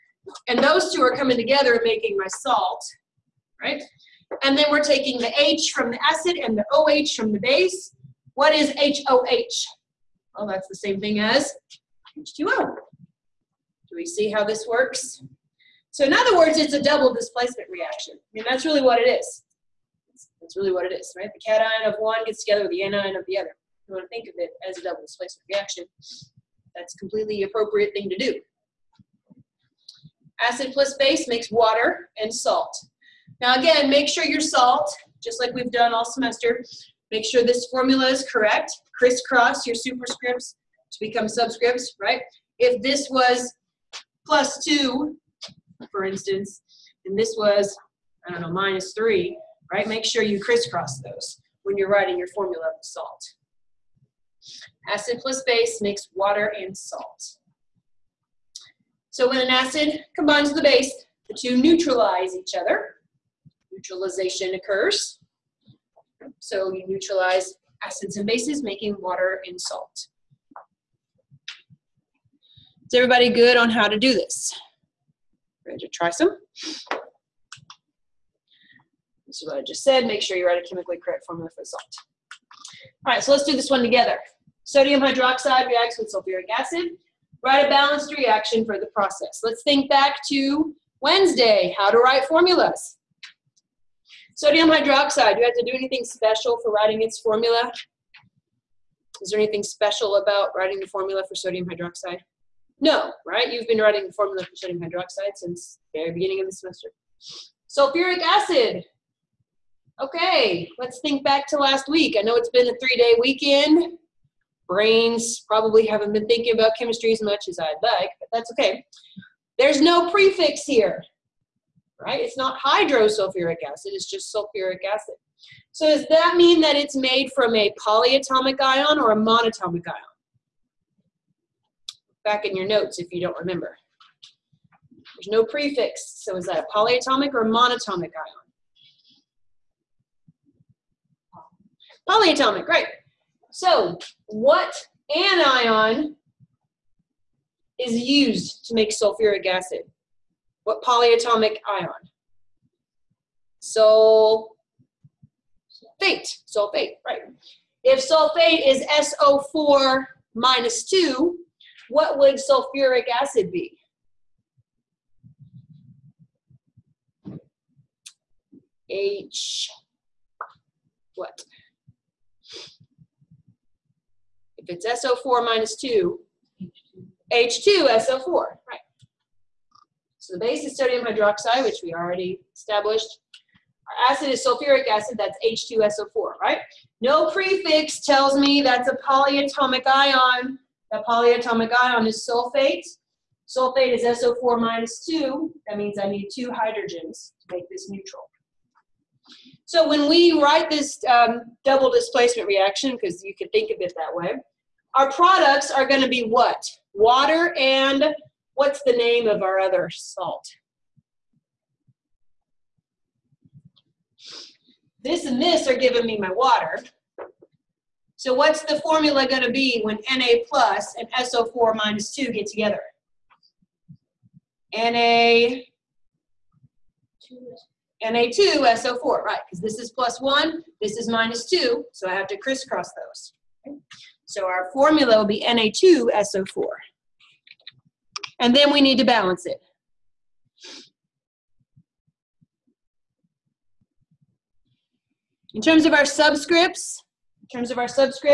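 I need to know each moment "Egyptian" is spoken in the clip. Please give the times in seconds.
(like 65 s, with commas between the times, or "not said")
not said.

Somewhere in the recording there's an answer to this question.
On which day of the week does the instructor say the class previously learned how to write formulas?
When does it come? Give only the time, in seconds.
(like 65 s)
91 s.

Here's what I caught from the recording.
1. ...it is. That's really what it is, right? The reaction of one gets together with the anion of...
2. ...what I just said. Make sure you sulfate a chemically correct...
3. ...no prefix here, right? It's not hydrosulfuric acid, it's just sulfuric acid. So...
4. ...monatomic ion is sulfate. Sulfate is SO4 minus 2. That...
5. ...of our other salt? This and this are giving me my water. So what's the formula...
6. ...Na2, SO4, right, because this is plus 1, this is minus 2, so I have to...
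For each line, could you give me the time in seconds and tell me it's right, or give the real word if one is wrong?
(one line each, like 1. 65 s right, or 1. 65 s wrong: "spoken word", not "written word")
1. 18 s wrong: "cation", not "reaction"
2. 79 s wrong: "write", not "sulfate"
3. 119 s right
4. 191 s wrong: "polyatomic", not "monatomic"
5. 209 s right
6. 228 s right.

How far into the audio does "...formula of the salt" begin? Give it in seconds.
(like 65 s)
52 s.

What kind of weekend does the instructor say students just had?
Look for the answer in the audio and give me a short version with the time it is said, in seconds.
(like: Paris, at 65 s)
Three-day weekend, at 112 s.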